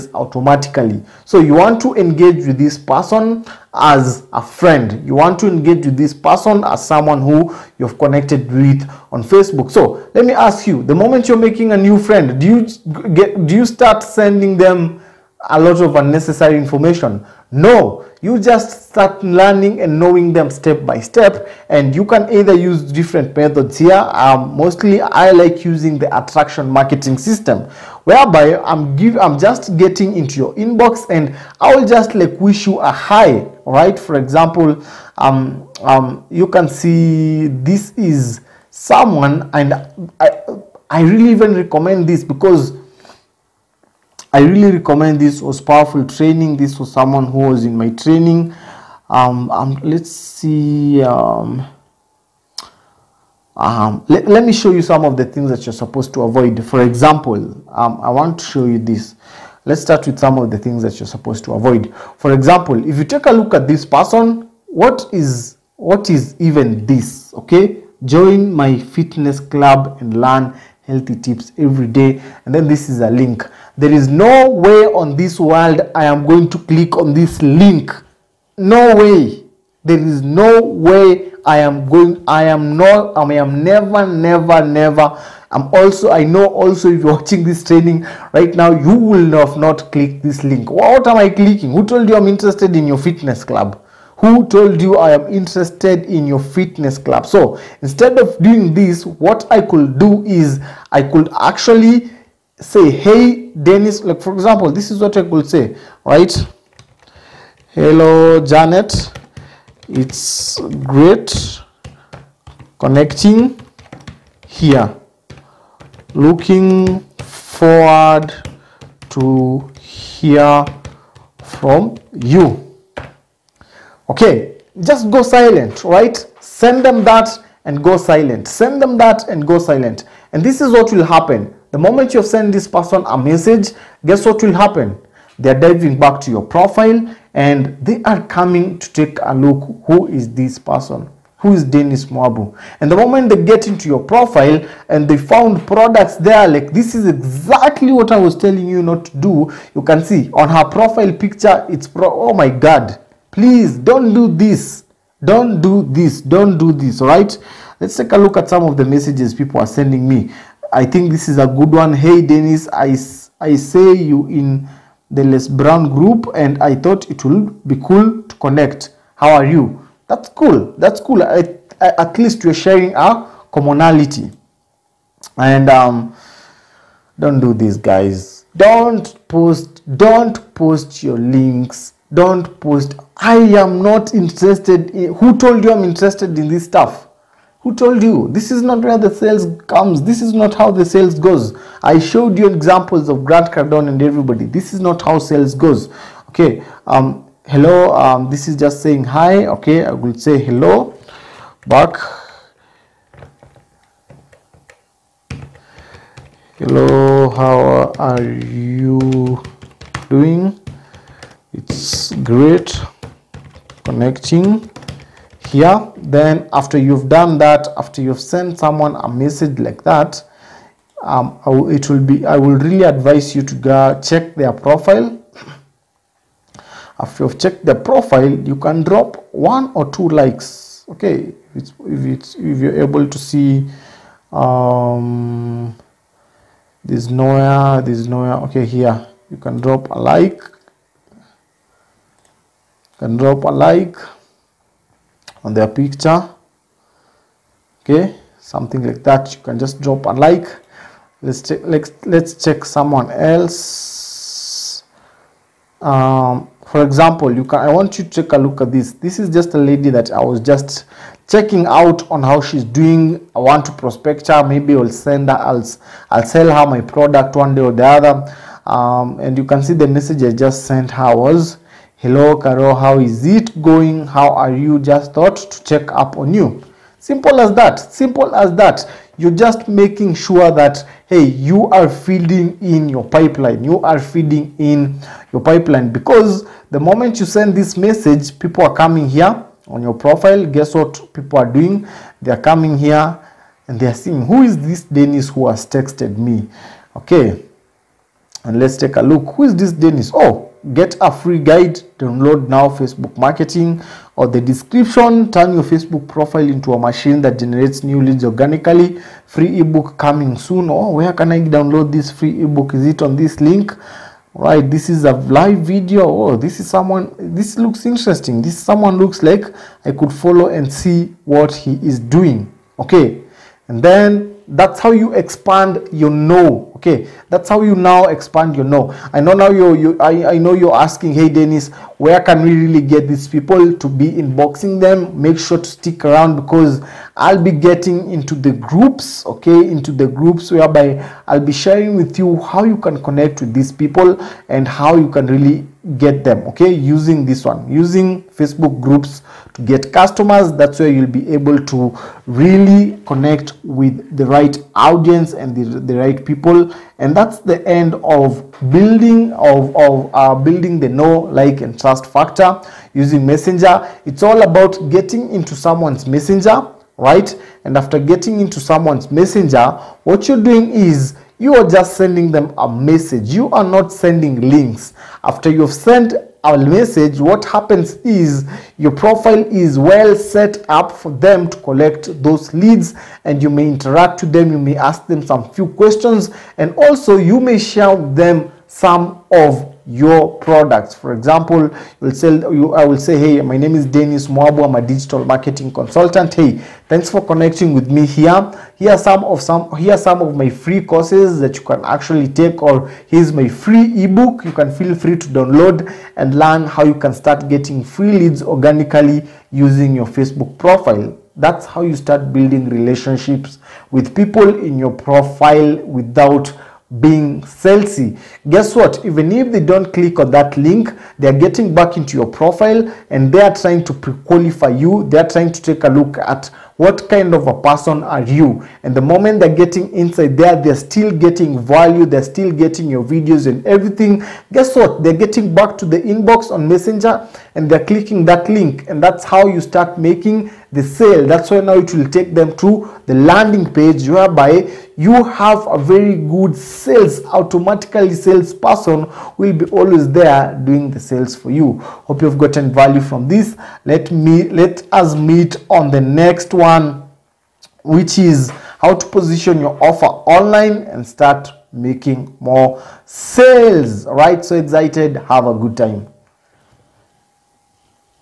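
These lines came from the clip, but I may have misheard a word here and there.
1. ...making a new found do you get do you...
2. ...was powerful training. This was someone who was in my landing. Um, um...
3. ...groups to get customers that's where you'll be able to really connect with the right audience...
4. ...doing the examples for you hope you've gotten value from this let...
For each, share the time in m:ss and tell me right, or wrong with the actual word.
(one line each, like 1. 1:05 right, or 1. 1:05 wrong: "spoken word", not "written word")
1. 0:11 wrong: "friend", not "found"
2. 0:45 wrong: "training", not "landing"
3. 5:48 right
4. 7:30 wrong: "sales", not "examples".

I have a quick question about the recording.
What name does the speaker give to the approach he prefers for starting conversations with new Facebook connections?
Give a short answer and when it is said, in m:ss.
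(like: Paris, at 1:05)
attraction marketing system, at 0:26.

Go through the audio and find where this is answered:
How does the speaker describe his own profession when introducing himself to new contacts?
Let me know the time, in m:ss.
6:34.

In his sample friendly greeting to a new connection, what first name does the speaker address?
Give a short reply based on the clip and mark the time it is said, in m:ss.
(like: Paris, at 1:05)
Janet, at 1:48.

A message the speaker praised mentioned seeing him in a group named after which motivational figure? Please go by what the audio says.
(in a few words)
Les Brown.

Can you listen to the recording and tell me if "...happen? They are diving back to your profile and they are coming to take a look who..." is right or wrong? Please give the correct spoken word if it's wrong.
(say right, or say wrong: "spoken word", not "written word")
right.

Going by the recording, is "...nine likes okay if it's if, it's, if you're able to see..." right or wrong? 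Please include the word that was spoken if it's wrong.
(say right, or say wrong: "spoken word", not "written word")
wrong: "two", not "nine".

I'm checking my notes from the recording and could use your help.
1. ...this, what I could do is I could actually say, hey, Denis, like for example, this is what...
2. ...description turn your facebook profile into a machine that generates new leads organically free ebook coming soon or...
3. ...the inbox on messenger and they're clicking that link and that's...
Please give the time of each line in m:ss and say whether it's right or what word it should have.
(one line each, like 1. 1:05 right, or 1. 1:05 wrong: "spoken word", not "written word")
1. 1:38 right
2. 5:04 right
3. 7:15 right.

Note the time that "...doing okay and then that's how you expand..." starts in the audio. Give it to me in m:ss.
5:21.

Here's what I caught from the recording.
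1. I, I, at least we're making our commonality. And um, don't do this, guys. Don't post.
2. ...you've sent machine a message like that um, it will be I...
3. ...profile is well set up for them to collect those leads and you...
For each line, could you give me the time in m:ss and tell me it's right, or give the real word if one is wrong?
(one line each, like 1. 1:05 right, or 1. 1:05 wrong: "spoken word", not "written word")
1. 2:51 wrong: "sharing", not "making"
2. 3:38 wrong: "someone", not "machine"
3. 6:18 right.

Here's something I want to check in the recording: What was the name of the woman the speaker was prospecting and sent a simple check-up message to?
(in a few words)
Carol.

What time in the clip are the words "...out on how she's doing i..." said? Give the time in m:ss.
4:21.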